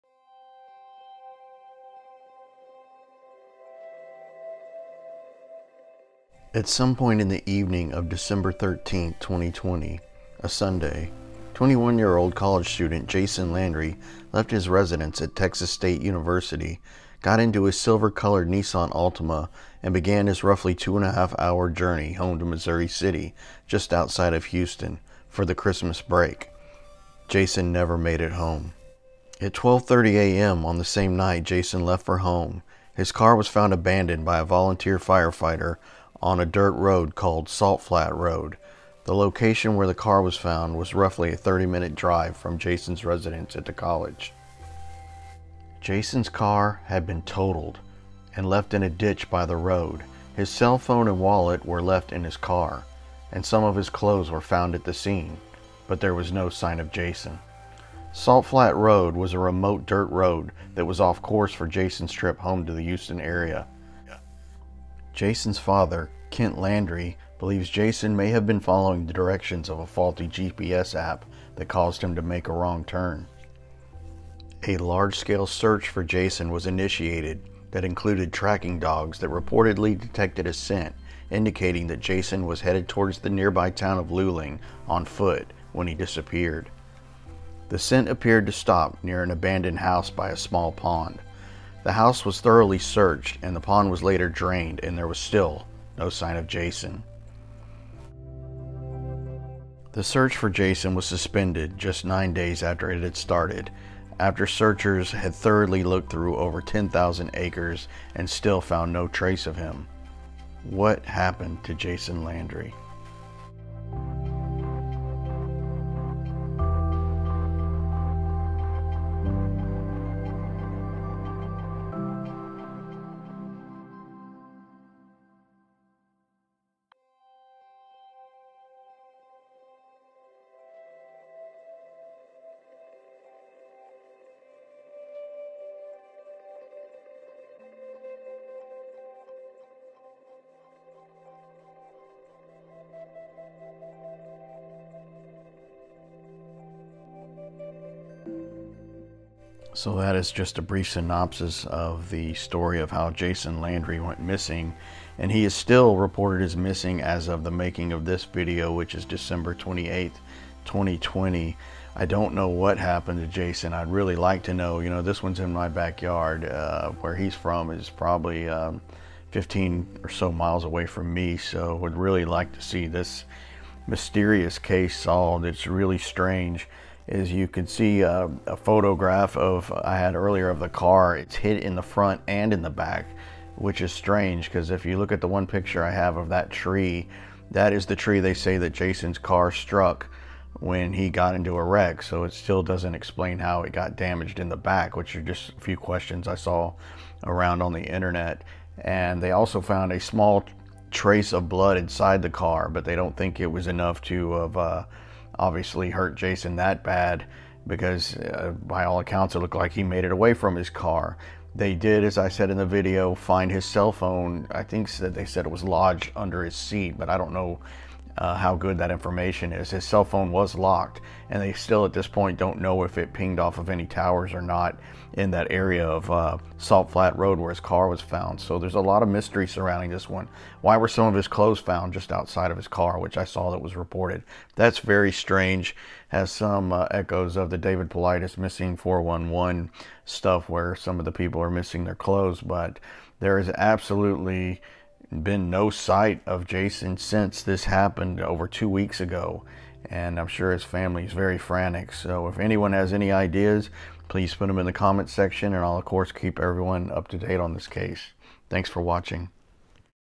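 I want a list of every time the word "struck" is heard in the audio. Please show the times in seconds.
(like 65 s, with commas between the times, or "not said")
189 s.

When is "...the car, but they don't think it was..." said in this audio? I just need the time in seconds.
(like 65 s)
202 s.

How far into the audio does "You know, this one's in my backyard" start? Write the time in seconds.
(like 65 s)
164 s.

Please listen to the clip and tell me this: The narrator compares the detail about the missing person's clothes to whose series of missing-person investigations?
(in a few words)
David Paulides.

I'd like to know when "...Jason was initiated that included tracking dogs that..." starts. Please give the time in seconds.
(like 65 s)
76 s.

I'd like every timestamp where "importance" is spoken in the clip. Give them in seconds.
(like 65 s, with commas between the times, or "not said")
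not said.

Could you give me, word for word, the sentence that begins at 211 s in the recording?
They did, as I said in the video, find his cell phone.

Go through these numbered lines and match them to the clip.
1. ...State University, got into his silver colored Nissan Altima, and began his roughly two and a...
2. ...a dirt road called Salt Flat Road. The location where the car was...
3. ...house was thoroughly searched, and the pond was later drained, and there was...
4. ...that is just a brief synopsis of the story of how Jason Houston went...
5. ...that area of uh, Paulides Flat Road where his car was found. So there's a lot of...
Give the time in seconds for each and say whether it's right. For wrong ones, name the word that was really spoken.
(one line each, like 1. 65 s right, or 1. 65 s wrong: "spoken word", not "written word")
1. 15 s right
2. 36 s right
3. 91 s right
4. 149 s wrong: "Landry", not "Houston"
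5. 225 s wrong: "Salt", not "Paulides".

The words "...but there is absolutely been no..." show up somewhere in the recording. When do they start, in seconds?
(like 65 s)
242 s.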